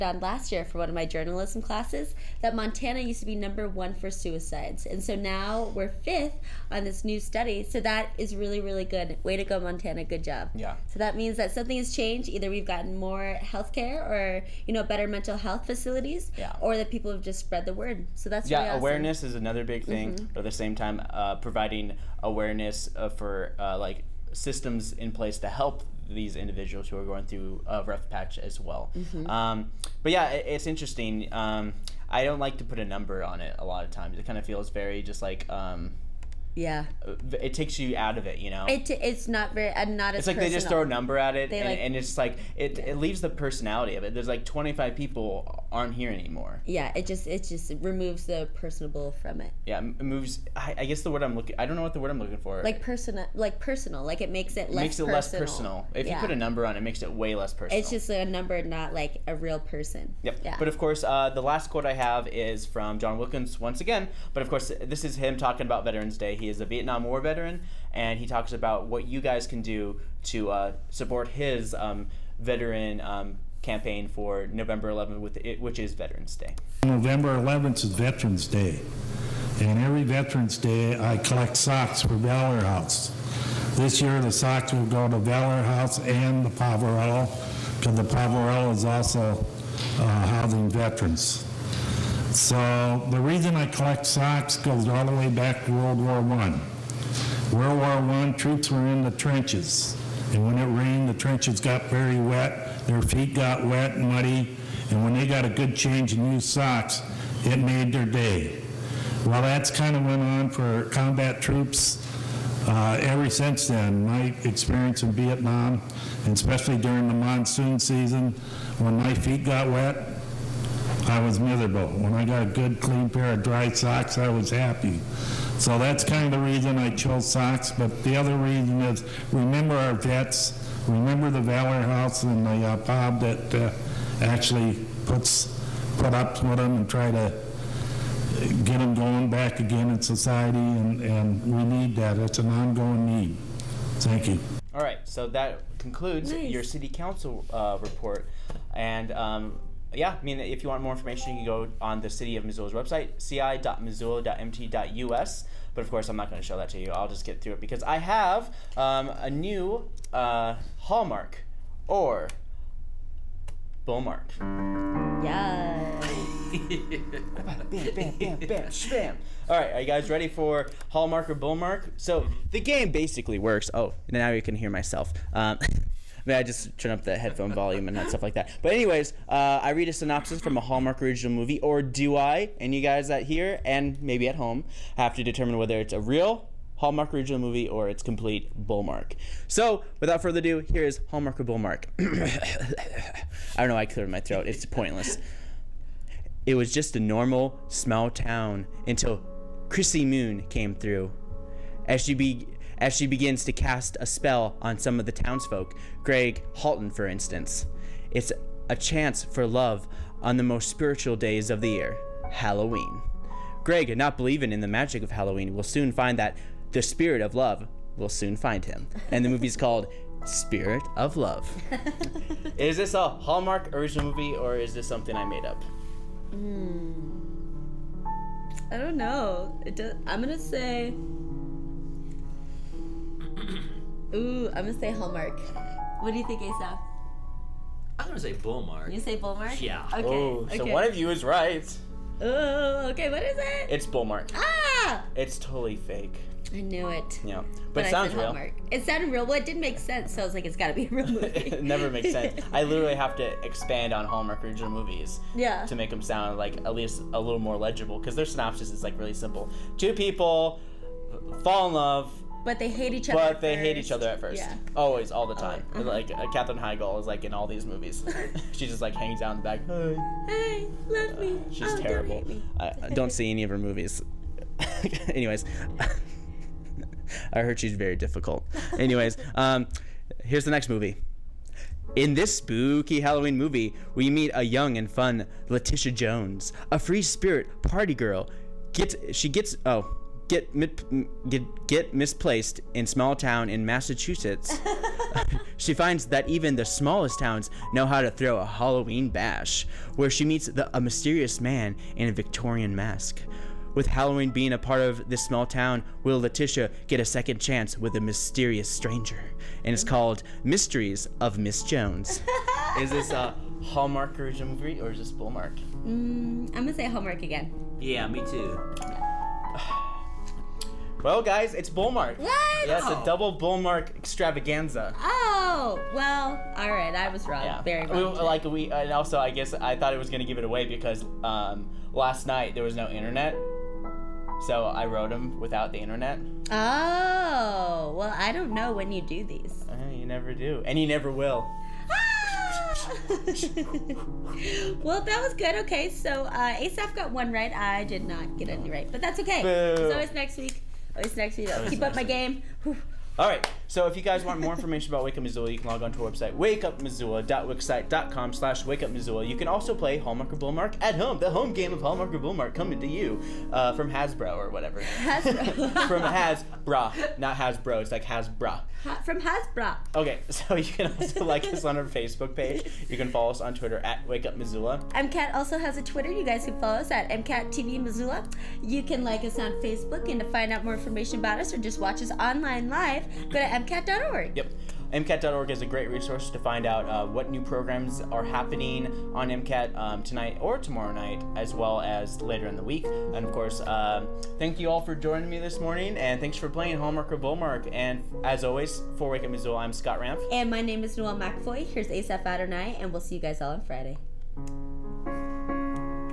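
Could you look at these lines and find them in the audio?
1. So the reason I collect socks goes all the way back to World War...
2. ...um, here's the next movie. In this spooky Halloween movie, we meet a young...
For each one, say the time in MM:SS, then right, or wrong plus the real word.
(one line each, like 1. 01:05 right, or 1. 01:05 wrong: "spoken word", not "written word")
1. 01:32 right
2. 04:39 right.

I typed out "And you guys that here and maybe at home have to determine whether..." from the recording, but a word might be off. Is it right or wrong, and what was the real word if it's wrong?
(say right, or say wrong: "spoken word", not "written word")
right.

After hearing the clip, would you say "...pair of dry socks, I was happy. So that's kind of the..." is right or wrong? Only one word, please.
right.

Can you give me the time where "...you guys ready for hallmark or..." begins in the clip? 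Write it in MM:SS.
02:49.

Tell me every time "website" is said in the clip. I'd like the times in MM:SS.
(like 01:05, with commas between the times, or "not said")
02:32, 05:56.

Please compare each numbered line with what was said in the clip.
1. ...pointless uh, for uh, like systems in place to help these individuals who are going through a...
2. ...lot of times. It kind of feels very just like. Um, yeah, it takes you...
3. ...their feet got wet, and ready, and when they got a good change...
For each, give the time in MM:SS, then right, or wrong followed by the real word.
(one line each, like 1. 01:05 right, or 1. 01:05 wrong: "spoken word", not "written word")
1. 00:22 wrong: "awareness", not "pointless"
2. 00:33 right
3. 01:42 wrong: "muddy", not "ready".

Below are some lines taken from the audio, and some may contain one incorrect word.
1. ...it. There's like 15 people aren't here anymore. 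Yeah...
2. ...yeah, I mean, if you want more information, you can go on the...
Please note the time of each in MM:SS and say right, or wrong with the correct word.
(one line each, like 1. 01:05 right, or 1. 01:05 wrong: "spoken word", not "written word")
1. 00:44 wrong: "25", not "15"
2. 02:29 right.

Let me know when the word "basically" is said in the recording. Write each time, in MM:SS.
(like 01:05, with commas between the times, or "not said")
02:52.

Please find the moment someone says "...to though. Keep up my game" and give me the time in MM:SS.
05:51.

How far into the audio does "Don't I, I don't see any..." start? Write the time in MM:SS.
04:32.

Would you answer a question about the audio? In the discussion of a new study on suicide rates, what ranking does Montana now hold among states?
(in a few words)
fifth.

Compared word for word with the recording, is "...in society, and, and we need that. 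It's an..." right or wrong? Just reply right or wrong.
right.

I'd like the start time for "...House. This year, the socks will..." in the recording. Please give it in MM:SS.
01:22.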